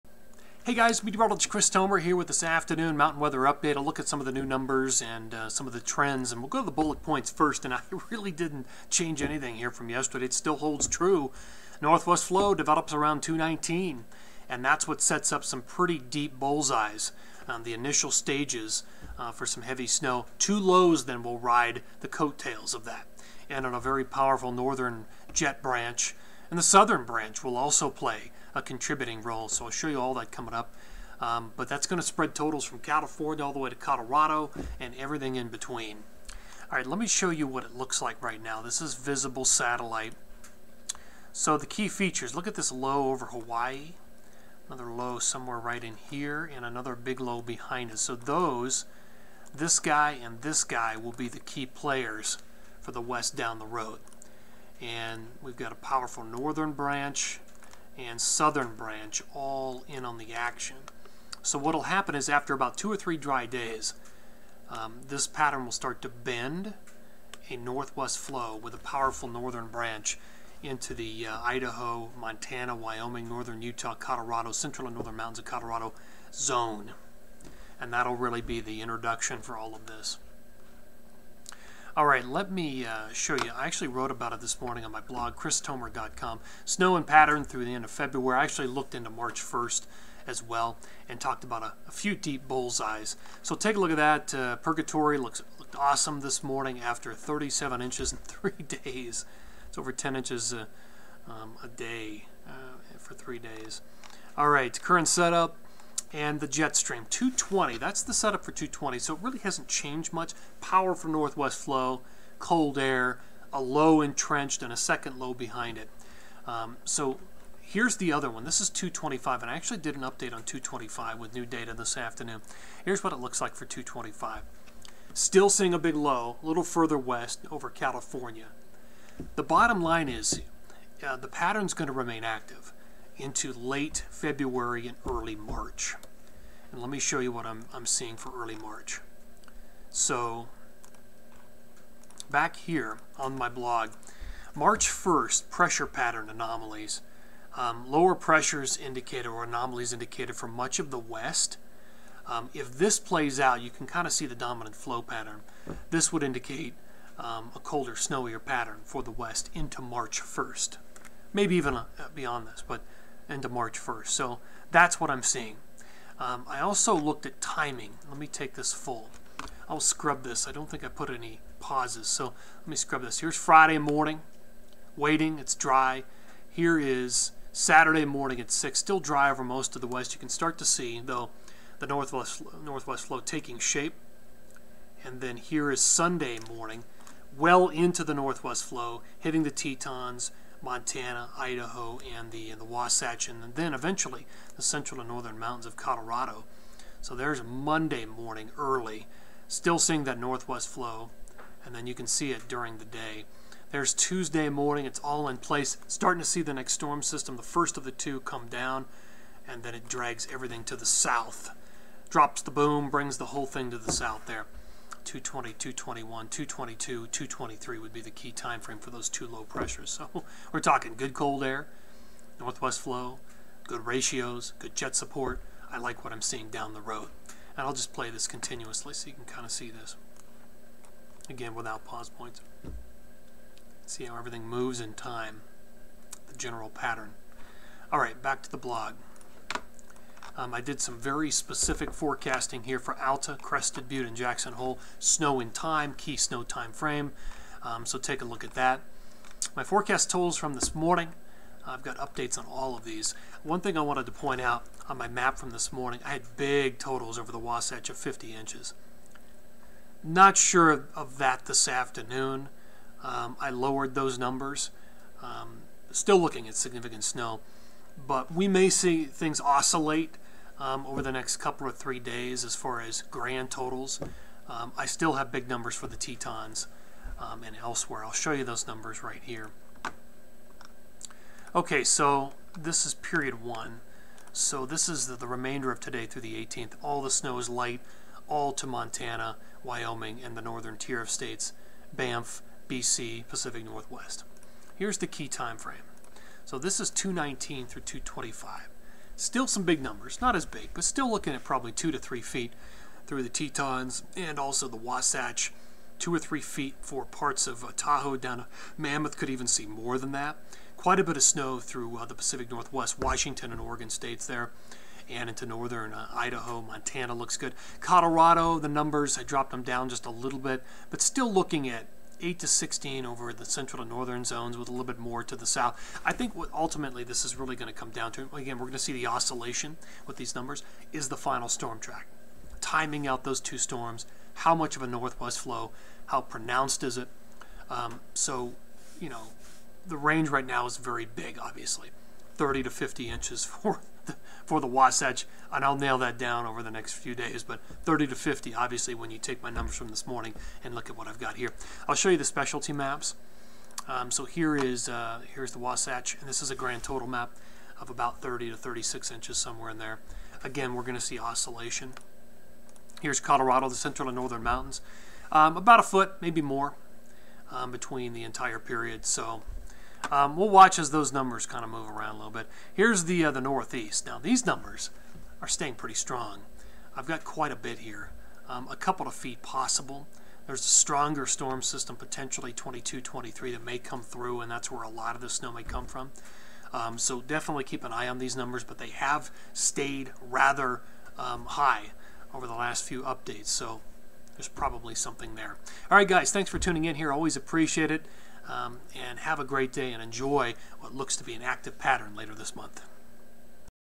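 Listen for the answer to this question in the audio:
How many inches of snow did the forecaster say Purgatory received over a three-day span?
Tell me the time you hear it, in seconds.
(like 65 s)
97 s.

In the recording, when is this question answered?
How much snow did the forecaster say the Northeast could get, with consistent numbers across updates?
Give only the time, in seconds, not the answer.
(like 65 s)
378 s.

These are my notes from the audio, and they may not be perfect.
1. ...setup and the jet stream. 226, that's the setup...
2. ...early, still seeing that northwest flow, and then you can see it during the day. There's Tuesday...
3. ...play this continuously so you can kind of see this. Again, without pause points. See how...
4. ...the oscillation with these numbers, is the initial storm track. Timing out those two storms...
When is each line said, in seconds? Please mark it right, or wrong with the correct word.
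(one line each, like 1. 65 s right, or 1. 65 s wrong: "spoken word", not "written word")
1. 105 s wrong: "220", not "226"
2. 198 s right
3. 227 s right
4. 328 s wrong: "final", not "initial".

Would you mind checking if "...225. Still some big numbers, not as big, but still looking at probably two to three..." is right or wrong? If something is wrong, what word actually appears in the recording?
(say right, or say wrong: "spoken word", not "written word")
right.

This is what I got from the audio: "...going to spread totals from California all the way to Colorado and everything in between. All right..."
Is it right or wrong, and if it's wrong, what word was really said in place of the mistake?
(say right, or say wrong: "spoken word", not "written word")
right.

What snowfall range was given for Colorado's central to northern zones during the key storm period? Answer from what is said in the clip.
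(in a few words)
8 to 16.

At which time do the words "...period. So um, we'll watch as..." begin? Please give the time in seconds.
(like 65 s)
368 s.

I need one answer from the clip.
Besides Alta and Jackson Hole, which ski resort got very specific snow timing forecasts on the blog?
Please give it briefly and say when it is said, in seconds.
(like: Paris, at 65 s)
Crested Butte, at 243 s.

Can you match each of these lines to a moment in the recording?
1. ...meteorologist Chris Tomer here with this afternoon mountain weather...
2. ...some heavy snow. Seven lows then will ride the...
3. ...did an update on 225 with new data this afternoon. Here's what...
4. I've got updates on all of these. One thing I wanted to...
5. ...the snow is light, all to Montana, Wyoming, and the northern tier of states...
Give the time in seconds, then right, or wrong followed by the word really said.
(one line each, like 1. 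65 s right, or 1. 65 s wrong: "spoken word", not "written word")
1. 1 s right
2. 19 s wrong: "Two", not "Seven"
3. 119 s right
4. 251 s right
5. 287 s right.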